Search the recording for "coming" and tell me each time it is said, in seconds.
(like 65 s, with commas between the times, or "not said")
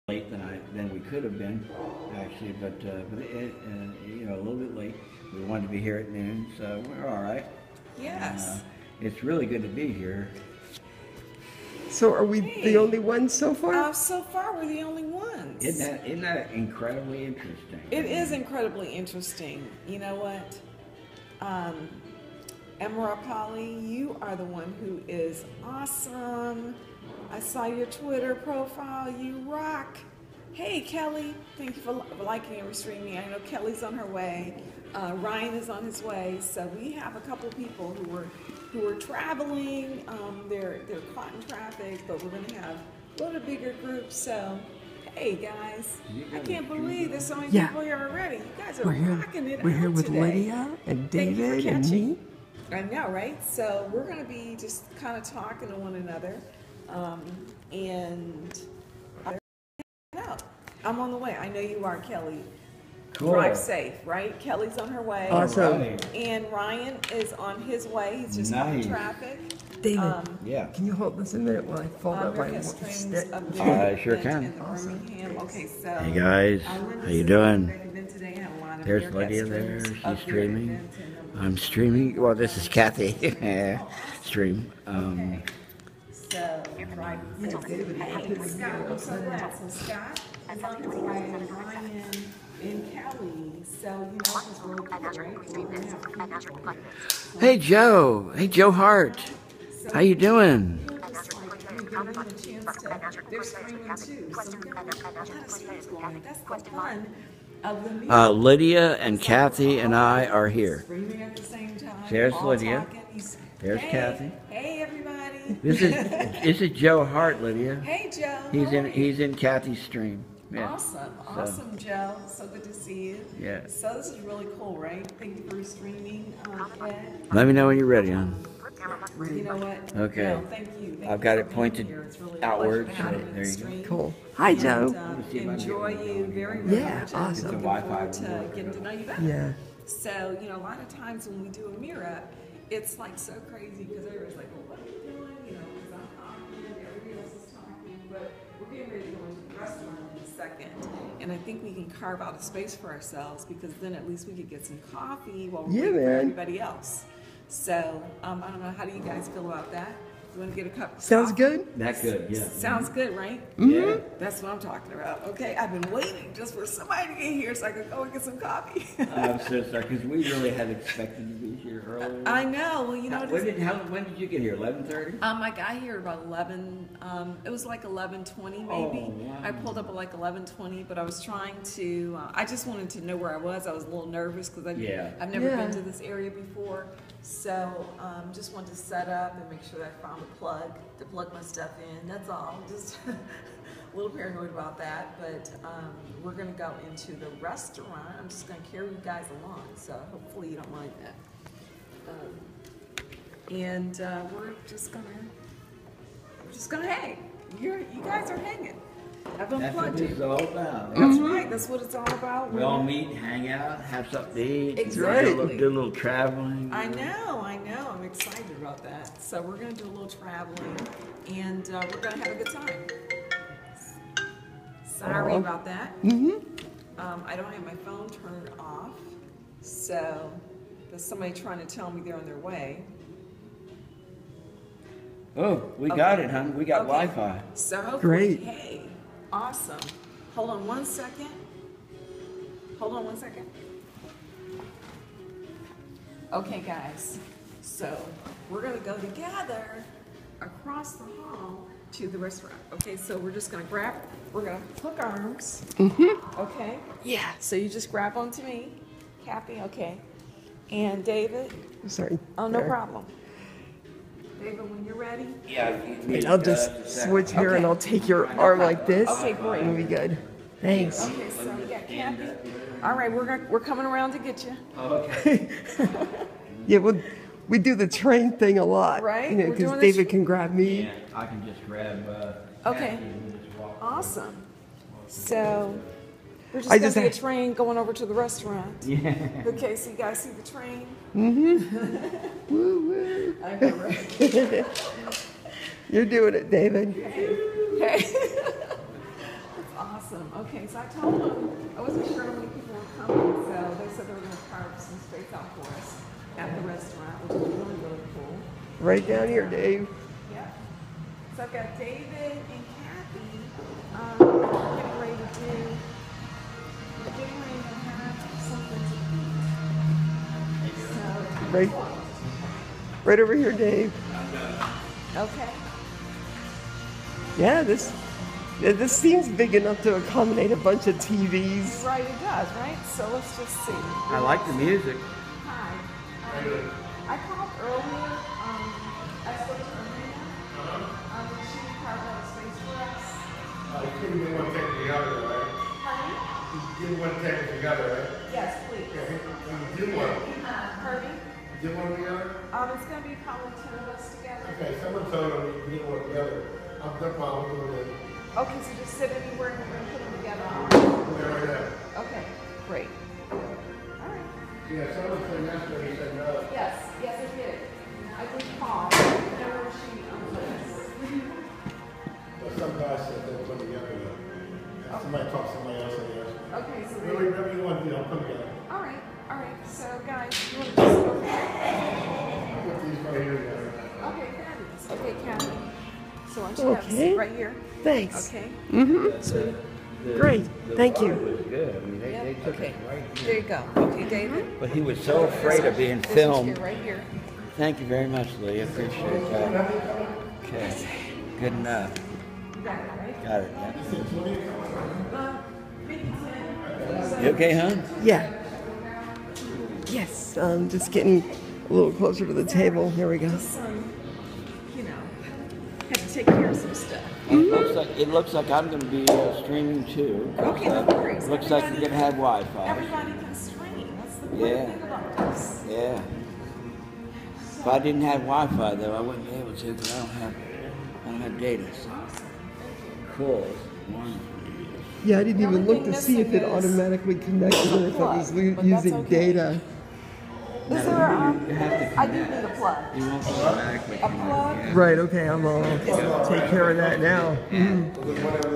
273 s, 303 s.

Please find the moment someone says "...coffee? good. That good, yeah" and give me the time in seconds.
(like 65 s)
161 s.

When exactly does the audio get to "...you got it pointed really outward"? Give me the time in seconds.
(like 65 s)
131 s.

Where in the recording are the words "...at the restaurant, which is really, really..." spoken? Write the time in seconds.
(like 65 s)
306 s.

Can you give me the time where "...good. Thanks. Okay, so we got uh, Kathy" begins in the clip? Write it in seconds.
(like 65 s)
269 s.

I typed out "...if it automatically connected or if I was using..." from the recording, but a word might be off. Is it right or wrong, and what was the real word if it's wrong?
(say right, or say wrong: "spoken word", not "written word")
right.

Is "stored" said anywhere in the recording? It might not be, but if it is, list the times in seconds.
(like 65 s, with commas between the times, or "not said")
not said.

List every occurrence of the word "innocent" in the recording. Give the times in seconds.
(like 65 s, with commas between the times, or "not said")
not said.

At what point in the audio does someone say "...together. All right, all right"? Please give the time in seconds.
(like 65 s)
378 s.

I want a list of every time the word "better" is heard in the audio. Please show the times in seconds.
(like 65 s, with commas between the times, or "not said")
139 s.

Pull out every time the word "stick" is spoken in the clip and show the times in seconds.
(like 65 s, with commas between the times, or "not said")
72 s.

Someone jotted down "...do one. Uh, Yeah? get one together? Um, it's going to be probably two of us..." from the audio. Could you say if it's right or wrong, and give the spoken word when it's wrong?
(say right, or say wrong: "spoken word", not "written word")
wrong: "Herbie", not "Yeah".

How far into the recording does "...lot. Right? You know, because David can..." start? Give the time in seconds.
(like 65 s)
278 s.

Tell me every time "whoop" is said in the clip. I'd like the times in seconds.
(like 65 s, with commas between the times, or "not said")
not said.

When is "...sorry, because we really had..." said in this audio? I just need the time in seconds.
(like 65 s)
169 s.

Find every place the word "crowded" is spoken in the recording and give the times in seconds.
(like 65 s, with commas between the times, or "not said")
not said.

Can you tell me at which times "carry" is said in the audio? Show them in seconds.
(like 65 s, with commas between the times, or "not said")
198 s.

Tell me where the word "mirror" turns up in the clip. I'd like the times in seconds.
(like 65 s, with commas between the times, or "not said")
141 s.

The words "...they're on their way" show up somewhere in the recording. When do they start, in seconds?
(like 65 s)
232 s.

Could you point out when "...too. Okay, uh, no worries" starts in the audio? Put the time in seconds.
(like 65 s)
419 s.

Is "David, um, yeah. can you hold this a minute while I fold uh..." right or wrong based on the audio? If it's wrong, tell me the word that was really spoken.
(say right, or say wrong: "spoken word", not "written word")
right.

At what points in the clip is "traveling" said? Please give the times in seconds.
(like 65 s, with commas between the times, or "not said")
38 s, 215 s, 220 s.